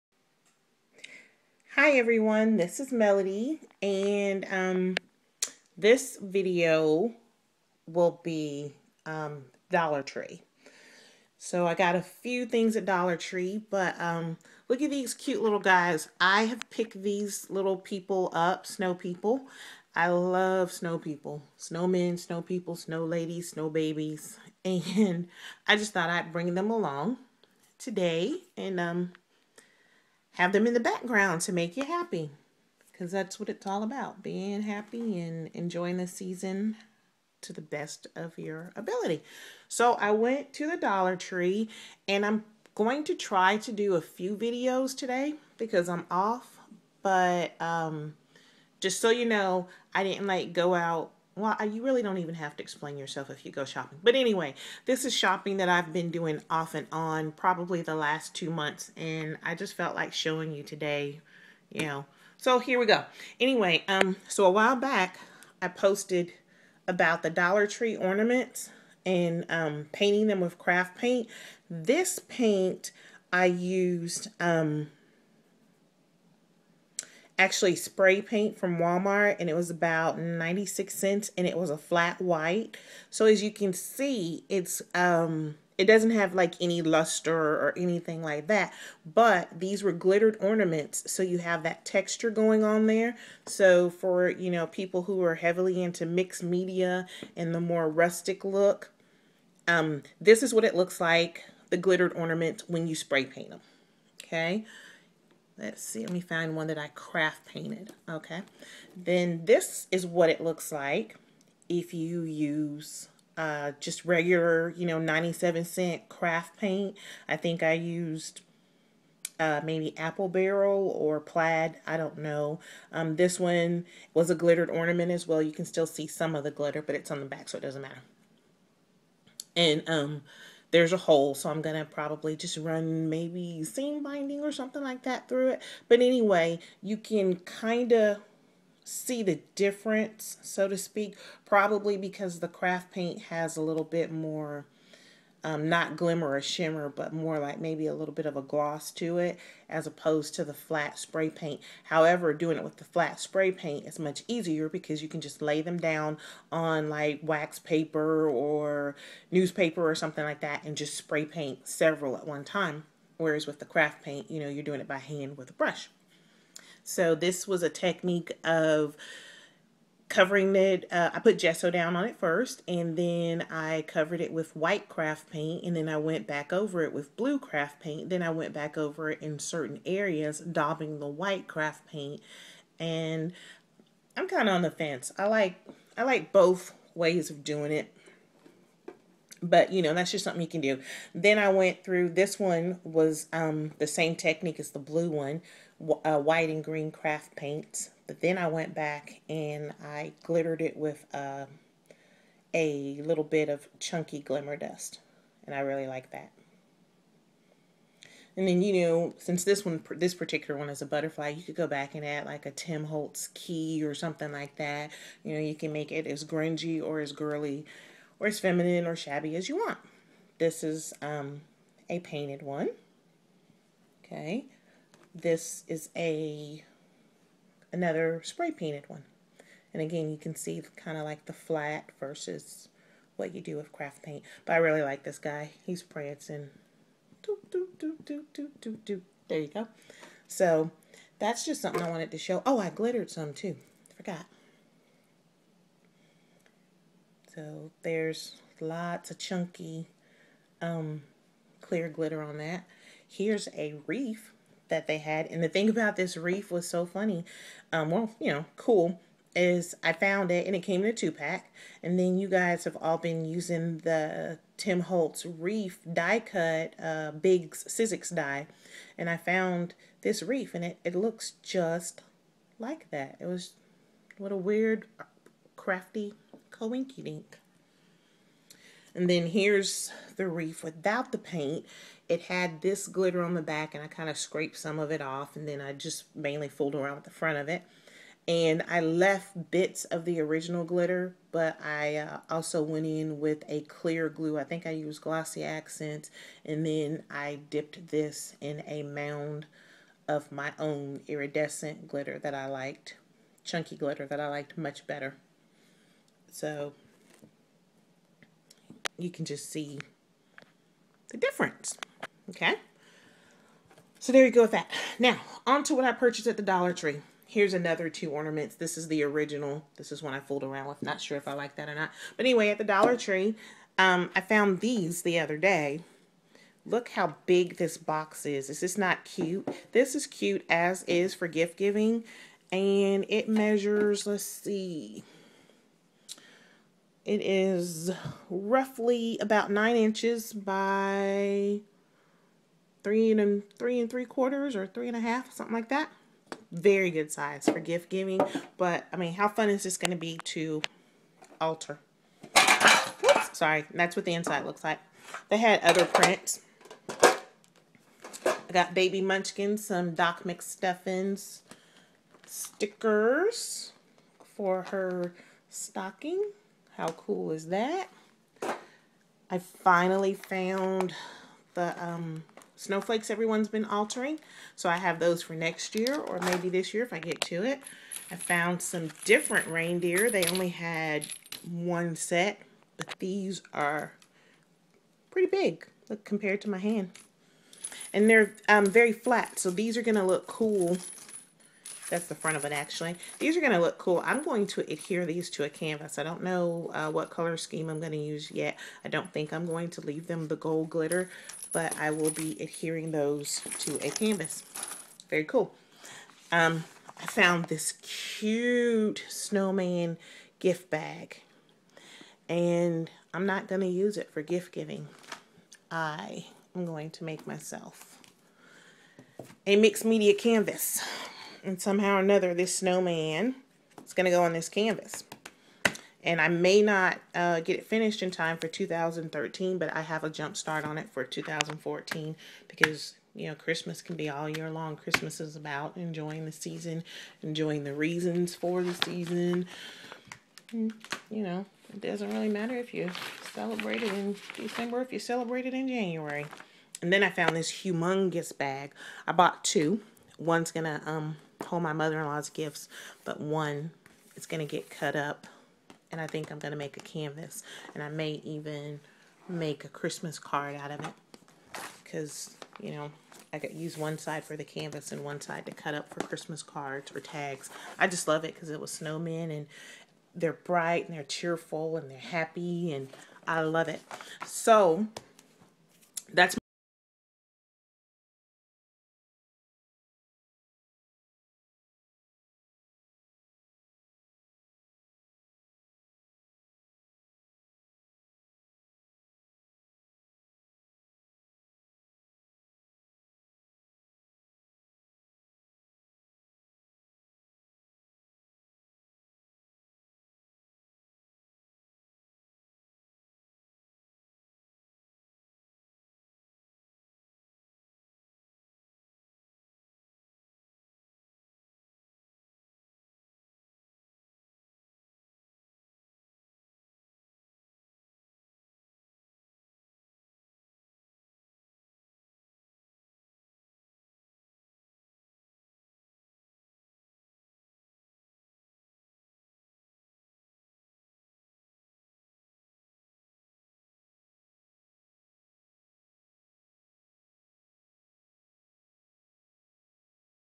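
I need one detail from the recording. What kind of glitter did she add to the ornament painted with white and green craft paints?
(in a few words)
chunky glimmer dust.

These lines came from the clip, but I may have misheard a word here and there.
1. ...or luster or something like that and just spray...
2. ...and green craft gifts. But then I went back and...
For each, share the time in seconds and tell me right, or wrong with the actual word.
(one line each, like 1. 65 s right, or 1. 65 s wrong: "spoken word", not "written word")
1. 158 s wrong: "newspaper", not "luster"
2. 196 s wrong: "paints", not "gifts".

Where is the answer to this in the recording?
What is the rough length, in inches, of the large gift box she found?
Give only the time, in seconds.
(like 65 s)
339 s.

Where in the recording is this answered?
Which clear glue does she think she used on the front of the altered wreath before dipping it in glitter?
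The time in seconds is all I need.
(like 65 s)
295 s.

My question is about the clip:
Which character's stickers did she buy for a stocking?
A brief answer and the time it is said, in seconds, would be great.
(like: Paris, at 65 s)
Doc McStuffins, at 359 s.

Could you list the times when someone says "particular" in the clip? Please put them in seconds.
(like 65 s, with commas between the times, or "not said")
210 s.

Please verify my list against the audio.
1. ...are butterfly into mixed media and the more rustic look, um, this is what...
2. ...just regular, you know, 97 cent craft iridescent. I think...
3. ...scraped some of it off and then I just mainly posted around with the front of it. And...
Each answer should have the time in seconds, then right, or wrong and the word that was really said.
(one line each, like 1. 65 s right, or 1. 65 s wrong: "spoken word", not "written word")
1. 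95 s wrong: "heavily", not "butterfly"
2. 113 s wrong: "paint", not "iridescent"
3. 284 s wrong: "fooled", not "posted".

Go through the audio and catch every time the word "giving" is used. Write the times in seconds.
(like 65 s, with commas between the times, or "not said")
331 s, 347 s, 414 s.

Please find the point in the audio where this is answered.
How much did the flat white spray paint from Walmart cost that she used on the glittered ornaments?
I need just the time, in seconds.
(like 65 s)
80 s.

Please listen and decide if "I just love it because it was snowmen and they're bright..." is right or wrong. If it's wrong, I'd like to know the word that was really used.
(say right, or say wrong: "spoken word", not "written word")
right.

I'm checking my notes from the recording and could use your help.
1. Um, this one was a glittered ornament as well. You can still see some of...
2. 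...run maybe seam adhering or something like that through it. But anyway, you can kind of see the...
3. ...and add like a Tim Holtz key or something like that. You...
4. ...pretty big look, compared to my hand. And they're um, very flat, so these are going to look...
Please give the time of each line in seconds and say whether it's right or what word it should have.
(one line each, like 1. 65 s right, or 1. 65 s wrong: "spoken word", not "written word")
1. 122 s right
2. 132 s wrong: "binding", not "adhering"
3. 211 s right
4. 385 s right.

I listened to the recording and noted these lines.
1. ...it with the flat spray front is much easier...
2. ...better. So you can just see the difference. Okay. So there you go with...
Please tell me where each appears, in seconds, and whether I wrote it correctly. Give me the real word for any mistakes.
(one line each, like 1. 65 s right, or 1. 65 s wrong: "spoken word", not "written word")
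1. 152 s wrong: "paint", not "front"
2. 304 s right.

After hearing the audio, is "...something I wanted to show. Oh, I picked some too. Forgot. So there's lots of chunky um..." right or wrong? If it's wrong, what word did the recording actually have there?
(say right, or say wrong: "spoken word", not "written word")
wrong: "glittered", not "picked".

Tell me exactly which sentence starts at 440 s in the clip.
And, you know, it doesn't really matter if you celebrate it in December, if you celebrate it in January.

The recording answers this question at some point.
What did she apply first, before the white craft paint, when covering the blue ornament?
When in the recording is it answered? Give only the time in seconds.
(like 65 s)
171 s.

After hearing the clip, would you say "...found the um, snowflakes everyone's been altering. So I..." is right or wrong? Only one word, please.
right.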